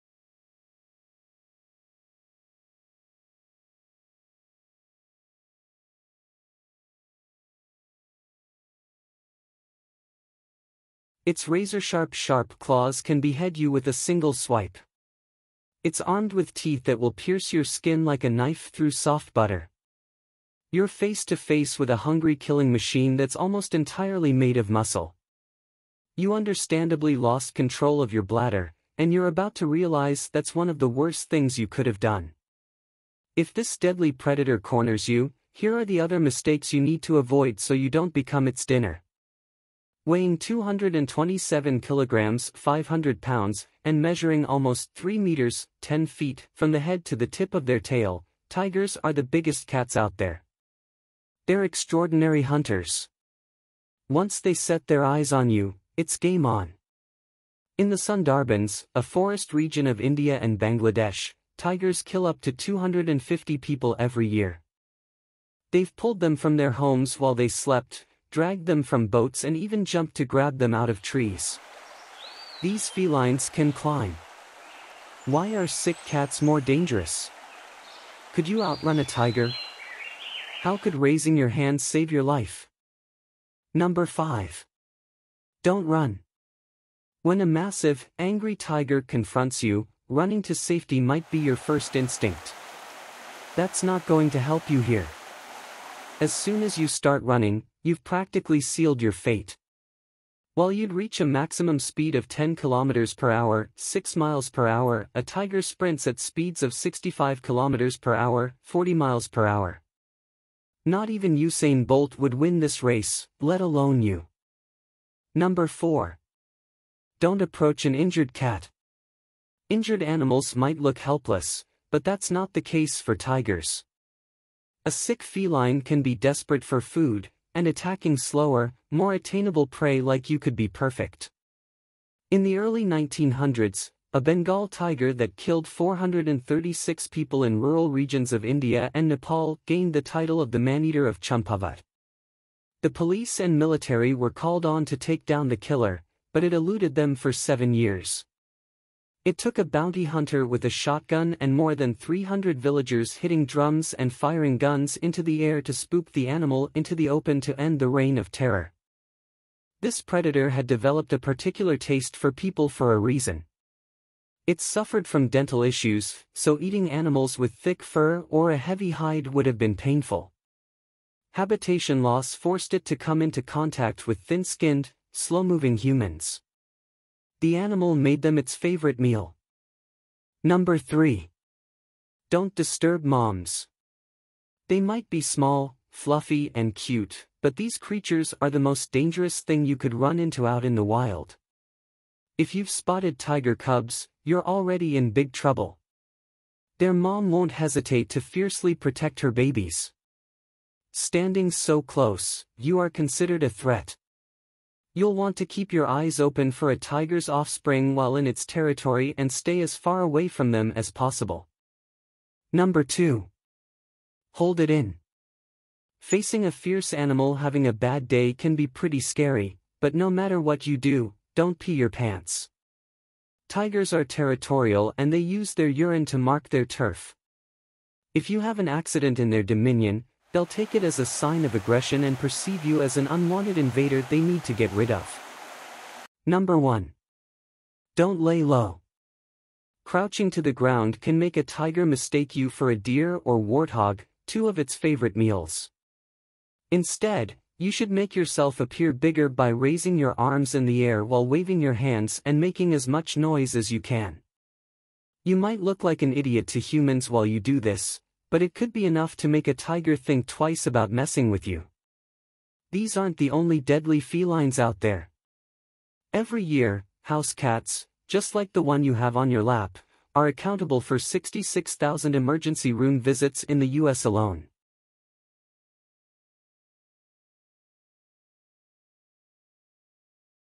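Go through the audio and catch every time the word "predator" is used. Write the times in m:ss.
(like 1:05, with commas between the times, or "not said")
0:34, 2:40.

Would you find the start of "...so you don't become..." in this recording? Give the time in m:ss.
0:37.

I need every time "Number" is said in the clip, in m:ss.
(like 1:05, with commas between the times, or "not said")
1:23, 1:55, 3:00, 3:32, 3:56.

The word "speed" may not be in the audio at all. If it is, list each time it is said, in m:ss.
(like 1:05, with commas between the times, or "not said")
1:41, 1:46.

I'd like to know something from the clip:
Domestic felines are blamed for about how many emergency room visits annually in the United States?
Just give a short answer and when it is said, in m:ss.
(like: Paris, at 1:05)
66,000, at 4:30.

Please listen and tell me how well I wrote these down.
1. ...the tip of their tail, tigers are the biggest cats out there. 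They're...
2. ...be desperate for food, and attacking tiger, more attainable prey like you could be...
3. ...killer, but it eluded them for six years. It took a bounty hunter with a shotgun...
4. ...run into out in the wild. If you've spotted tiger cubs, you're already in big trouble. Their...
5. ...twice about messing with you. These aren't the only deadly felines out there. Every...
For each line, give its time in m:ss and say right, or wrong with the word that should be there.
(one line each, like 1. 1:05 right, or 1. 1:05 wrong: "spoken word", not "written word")
1. 0:47 right
2. 2:06 wrong: "slower", not "tiger"
3. 2:25 wrong: "seven", not "six"
4. 3:09 right
5. 4:20 right.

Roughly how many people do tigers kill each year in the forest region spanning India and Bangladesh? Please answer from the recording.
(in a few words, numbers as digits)
250.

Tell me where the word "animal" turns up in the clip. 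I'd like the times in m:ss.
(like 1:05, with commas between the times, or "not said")
2:00, 2:36, 2:46, 2:57, 3:36.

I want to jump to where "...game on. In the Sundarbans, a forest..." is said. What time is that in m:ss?
0:56.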